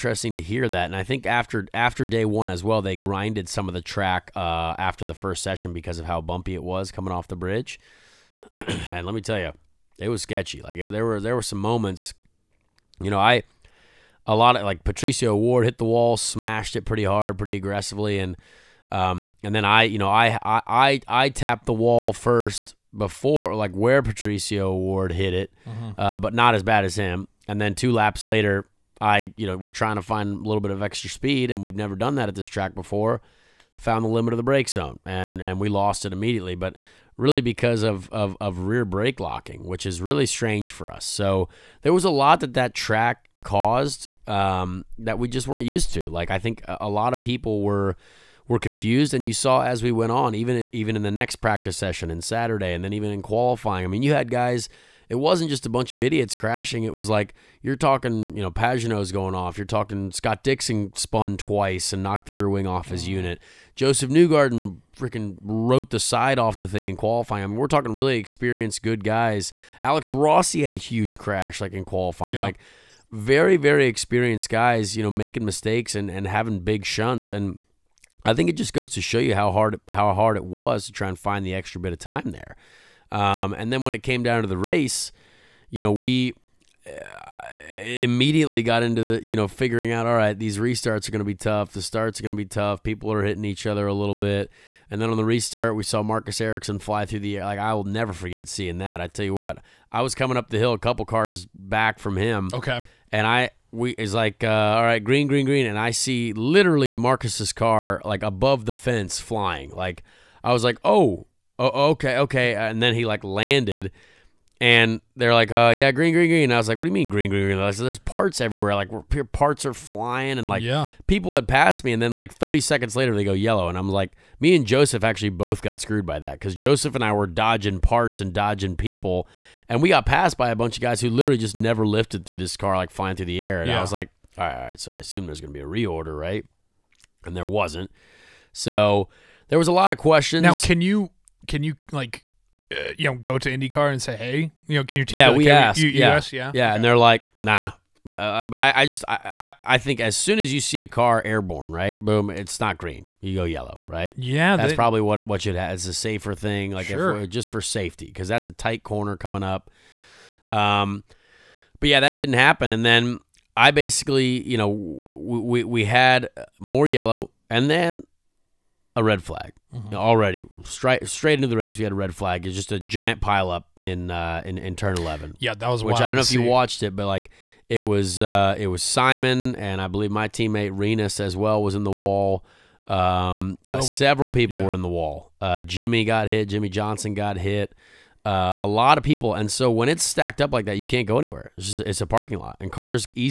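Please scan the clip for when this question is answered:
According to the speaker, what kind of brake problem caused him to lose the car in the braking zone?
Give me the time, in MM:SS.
00:38.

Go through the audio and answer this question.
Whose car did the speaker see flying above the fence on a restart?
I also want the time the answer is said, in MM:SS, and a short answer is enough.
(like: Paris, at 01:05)
Marcus Ericsson, at 01:36.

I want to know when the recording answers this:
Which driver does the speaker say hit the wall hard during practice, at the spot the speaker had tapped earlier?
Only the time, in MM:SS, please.
00:24.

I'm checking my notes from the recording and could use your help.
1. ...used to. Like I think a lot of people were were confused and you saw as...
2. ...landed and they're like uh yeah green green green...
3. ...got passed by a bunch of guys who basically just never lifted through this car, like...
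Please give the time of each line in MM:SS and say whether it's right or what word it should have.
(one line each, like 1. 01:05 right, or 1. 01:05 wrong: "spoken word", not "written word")
1. 00:45 right
2. 01:53 right
3. 02:09 wrong: "literally", not "basically".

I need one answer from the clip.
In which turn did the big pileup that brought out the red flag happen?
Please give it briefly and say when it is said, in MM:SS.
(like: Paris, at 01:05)
Turn 11, at 02:54.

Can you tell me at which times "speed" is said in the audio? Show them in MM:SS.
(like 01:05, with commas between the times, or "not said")
00:31.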